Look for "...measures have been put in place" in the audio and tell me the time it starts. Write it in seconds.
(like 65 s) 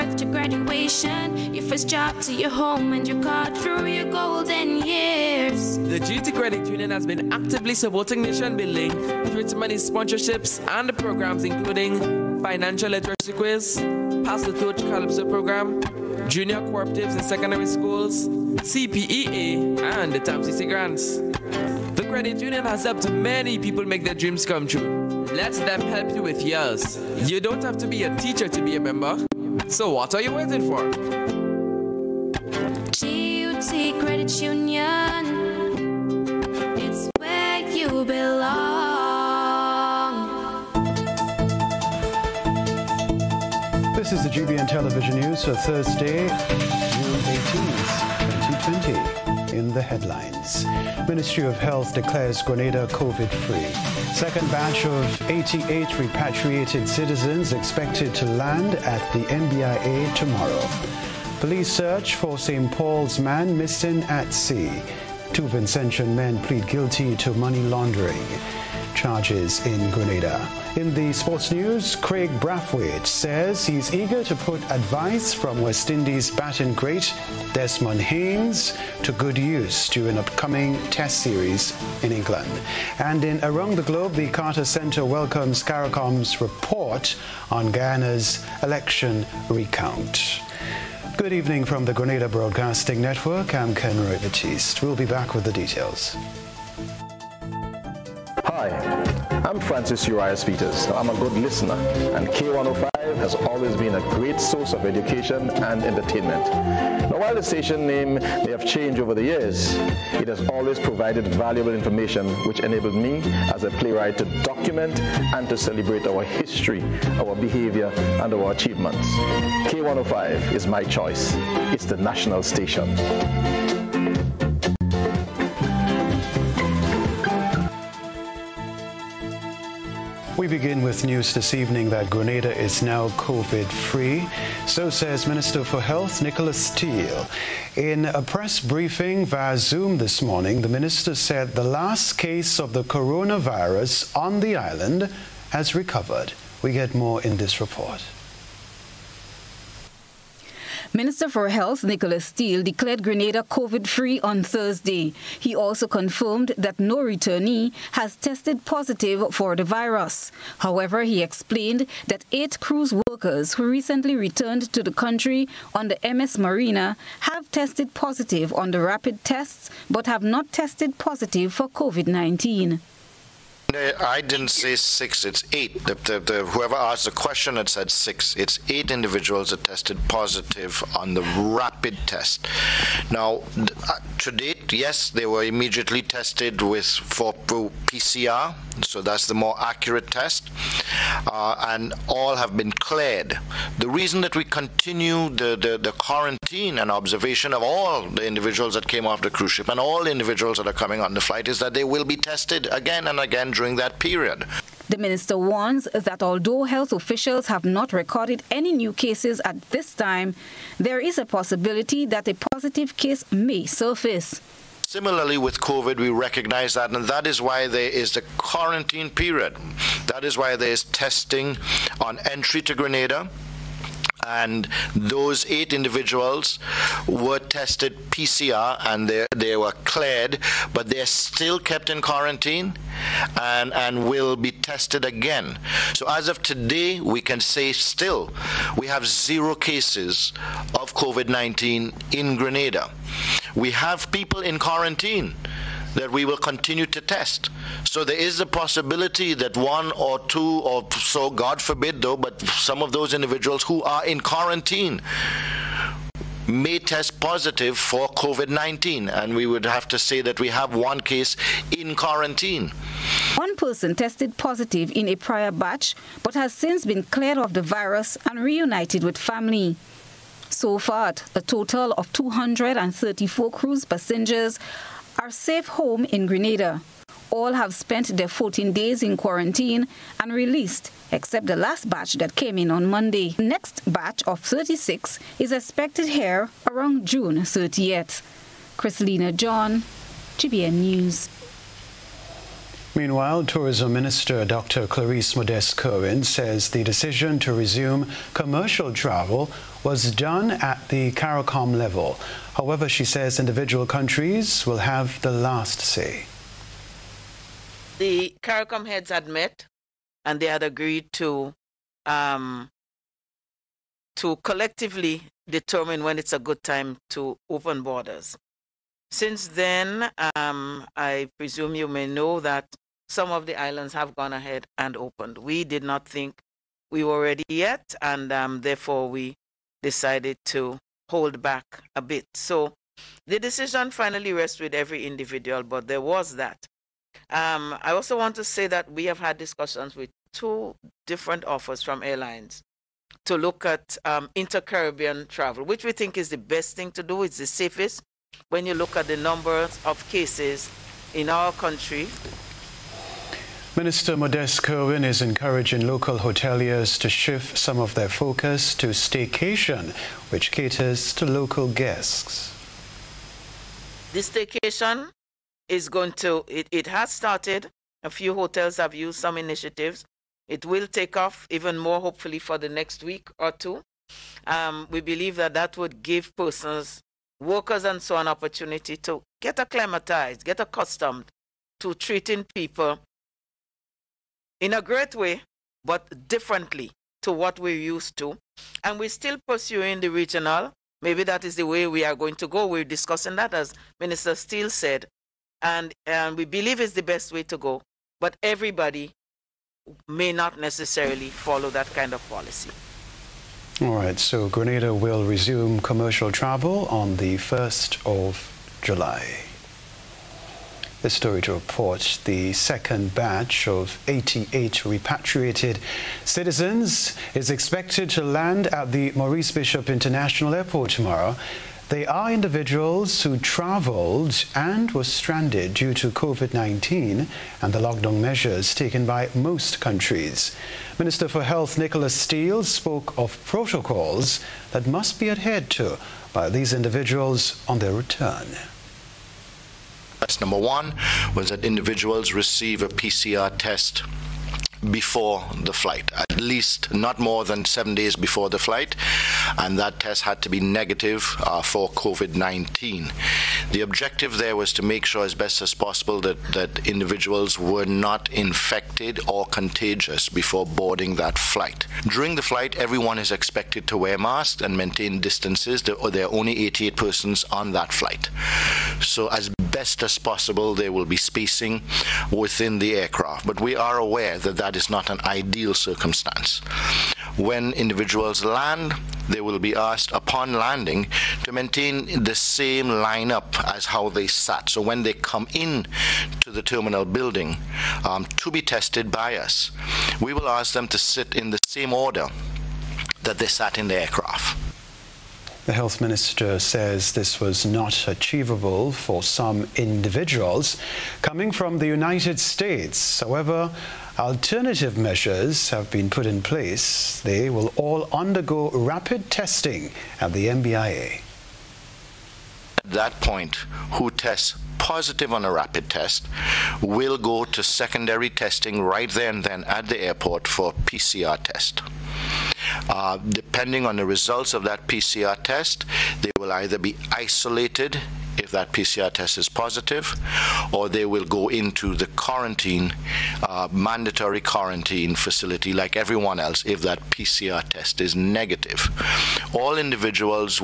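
504 s.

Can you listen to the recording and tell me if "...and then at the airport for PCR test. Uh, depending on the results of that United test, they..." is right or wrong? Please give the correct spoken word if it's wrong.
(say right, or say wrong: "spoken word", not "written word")
wrong: "PCR", not "United".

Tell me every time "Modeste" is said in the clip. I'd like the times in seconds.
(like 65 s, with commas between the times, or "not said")
295 s, 354 s.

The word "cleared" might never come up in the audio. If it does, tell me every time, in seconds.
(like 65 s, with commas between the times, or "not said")
192 s, 229 s, 267 s.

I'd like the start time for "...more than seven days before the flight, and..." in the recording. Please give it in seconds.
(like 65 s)
447 s.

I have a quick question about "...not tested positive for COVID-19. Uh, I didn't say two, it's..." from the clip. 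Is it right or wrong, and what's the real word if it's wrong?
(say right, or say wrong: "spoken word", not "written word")
wrong: "six", not "two".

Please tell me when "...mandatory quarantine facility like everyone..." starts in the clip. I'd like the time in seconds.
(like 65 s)
533 s.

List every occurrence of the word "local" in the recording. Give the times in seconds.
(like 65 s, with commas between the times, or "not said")
355 s, 361 s.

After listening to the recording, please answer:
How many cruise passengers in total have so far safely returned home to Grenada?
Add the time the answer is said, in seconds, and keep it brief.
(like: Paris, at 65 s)
234, at 272 s.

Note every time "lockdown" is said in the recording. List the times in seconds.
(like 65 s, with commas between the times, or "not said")
427 s.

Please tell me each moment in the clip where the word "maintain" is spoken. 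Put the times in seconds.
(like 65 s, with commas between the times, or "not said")
464 s, 481 s.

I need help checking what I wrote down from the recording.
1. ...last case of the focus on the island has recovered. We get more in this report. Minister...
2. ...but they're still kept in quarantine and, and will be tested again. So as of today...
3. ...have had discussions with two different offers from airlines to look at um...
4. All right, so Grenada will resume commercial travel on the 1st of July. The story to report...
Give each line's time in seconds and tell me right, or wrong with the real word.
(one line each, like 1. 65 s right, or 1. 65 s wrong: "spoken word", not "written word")
1. 141 s wrong: "coronavirus", not "focus"
2. 230 s right
3. 339 s right
4. 403 s right.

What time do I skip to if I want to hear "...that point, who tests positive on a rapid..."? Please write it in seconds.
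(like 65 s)
512 s.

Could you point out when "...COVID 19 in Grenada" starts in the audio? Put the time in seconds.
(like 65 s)
240 s.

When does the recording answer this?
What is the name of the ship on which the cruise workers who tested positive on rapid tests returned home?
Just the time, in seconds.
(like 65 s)
166 s.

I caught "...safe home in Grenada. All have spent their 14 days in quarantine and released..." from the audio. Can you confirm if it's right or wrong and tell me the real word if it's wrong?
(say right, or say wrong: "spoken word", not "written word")
right.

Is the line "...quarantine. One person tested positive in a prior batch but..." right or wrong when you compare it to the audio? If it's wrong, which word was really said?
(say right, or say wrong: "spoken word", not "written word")
right.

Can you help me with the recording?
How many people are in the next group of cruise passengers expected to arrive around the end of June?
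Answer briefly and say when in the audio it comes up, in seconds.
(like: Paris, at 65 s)
36, at 284 s.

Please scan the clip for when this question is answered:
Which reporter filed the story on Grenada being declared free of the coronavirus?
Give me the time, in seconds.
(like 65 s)
288 s.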